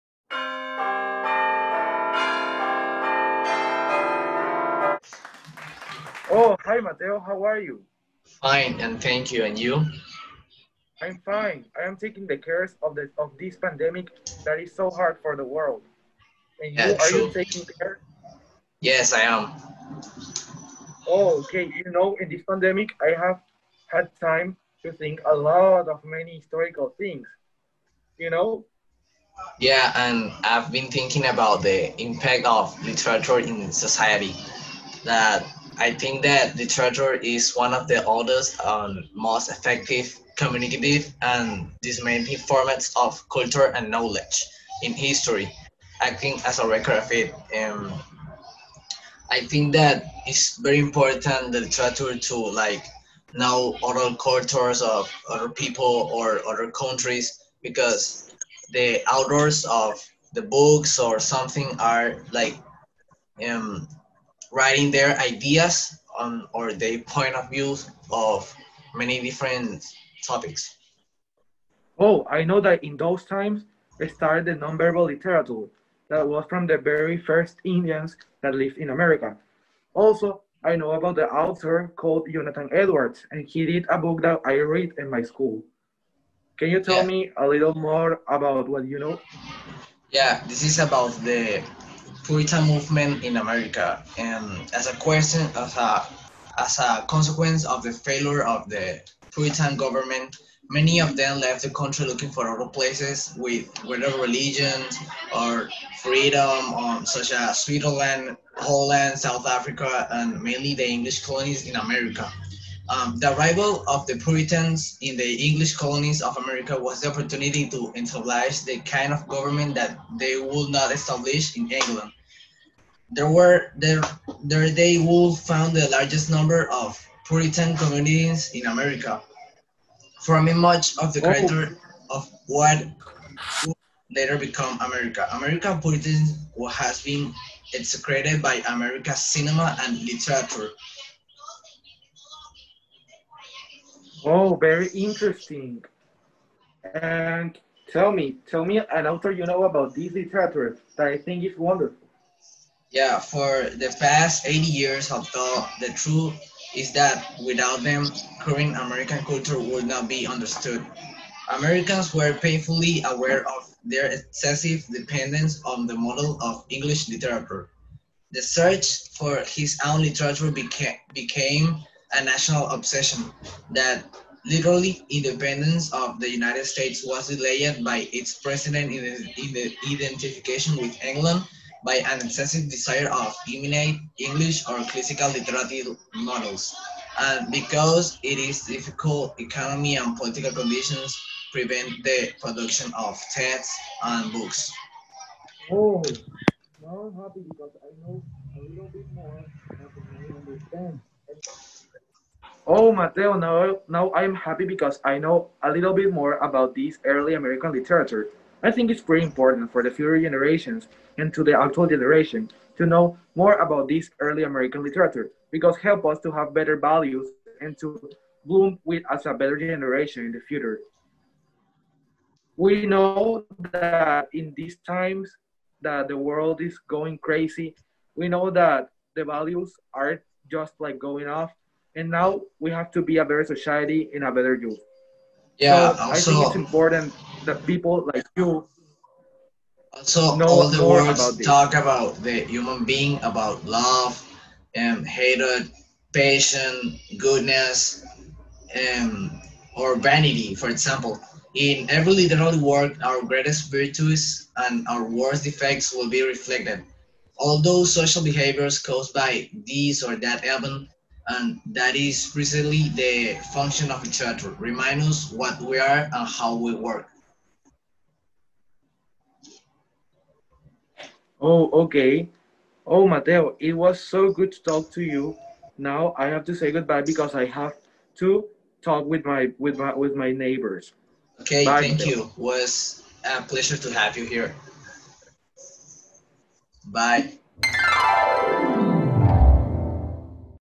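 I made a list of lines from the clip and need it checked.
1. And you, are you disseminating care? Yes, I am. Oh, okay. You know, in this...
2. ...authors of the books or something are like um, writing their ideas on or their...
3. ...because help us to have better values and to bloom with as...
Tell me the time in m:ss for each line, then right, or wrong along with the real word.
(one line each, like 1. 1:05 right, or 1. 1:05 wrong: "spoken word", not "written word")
1. 0:16 wrong: "taking", not "disseminating"
2. 0:59 right
3. 3:35 right.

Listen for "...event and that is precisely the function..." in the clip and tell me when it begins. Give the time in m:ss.
4:20.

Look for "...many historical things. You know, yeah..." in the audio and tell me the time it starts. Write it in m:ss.
0:26.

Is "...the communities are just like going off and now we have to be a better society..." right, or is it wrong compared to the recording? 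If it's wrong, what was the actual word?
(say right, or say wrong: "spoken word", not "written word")
wrong: "values", not "communities".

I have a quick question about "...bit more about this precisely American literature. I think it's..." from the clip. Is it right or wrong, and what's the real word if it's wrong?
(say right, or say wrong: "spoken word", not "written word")
wrong: "early", not "precisely".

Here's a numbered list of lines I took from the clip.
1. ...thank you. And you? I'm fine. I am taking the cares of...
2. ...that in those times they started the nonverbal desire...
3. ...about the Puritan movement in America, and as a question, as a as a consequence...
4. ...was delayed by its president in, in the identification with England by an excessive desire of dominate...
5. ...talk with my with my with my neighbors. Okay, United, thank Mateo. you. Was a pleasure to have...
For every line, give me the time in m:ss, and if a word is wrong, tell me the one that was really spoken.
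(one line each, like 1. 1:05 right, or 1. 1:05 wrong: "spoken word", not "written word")
1. 0:09 right
2. 1:12 wrong: "literature", not "desire"
3. 1:30 right
4. 2:57 right
5. 4:38 wrong: "Bye", not "United".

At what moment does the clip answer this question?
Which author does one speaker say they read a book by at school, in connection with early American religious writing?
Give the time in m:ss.
1:22.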